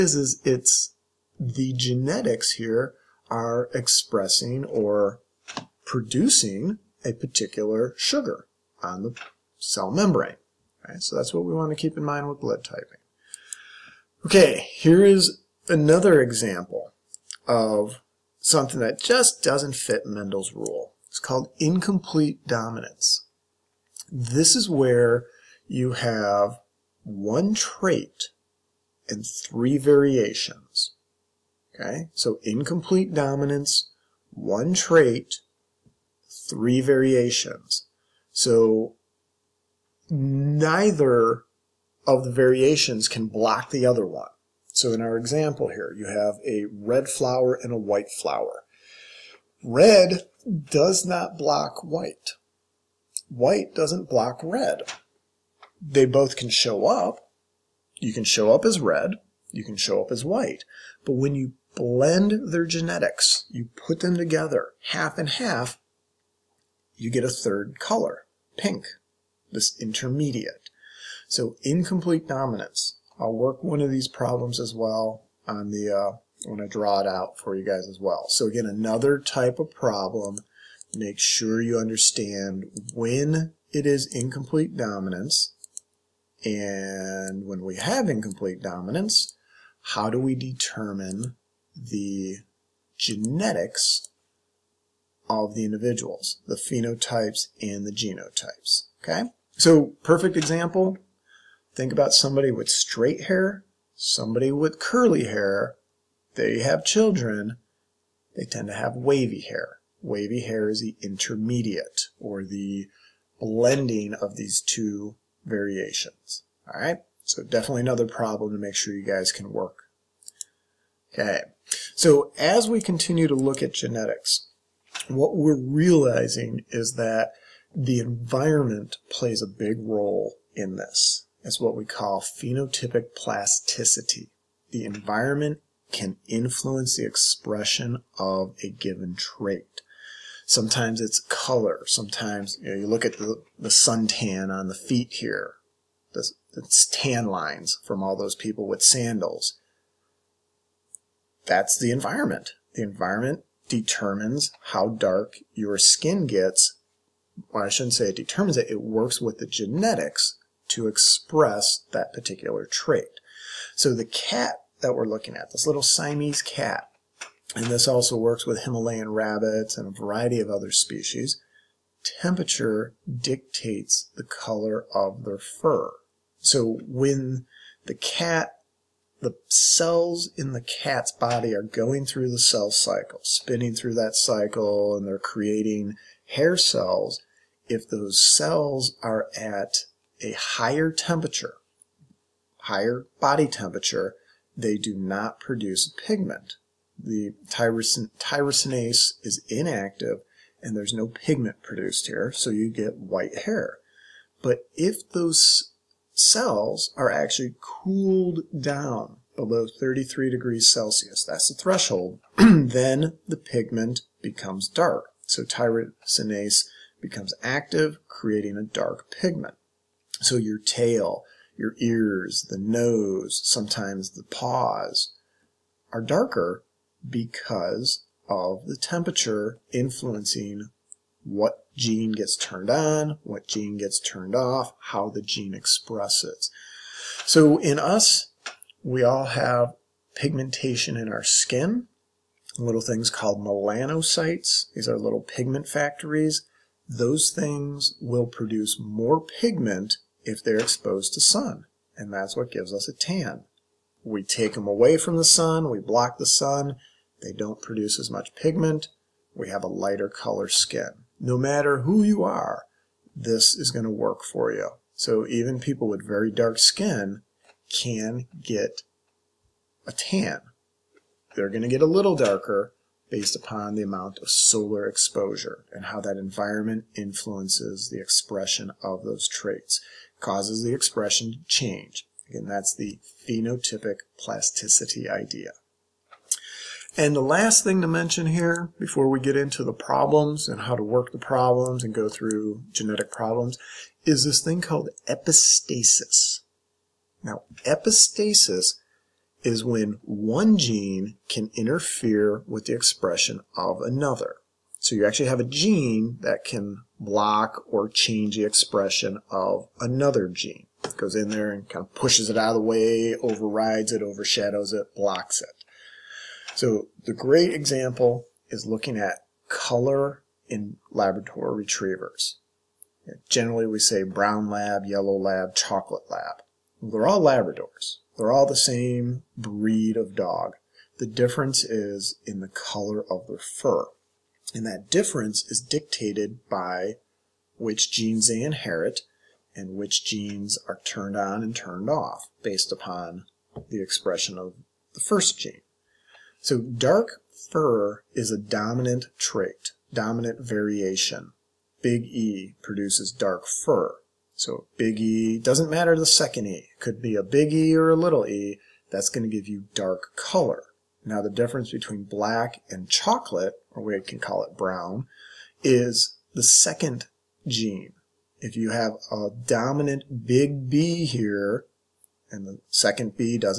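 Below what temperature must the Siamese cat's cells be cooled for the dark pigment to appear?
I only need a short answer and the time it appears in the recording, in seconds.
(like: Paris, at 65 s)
33 degrees Celsius, at 209 s.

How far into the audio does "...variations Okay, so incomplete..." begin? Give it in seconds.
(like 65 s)
29 s.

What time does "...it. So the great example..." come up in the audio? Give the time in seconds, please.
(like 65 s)
315 s.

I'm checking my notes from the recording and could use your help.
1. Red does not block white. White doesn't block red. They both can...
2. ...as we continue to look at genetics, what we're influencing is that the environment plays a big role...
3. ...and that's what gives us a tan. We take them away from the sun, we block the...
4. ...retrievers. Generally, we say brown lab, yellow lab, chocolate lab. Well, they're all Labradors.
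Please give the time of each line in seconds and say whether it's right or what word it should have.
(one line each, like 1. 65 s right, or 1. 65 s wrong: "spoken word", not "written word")
1. 49 s right
2. 122 s wrong: "realizing", not "influencing"
3. 251 s right
4. 321 s right.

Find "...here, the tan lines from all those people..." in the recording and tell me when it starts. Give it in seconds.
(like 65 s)
145 s.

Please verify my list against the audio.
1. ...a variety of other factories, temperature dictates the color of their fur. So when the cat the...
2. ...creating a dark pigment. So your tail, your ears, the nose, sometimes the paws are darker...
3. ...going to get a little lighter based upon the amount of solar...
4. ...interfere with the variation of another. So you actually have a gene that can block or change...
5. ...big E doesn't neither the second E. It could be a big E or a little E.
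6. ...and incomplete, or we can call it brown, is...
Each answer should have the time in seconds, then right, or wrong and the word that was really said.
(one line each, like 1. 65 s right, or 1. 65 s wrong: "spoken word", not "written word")
1. 169 s wrong: "species", not "factories"
2. 218 s right
3. 271 s wrong: "darker", not "lighter"
4. 301 s wrong: "expression", not "variation"
5. 354 s wrong: "matter", not "neither"
6. 362 s wrong: "chocolate", not "incomplete".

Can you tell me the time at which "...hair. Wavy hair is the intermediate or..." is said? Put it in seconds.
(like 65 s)
109 s.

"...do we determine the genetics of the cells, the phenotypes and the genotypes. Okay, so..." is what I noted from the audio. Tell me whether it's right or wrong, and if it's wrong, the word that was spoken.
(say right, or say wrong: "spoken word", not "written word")
wrong: "individuals", not "cells".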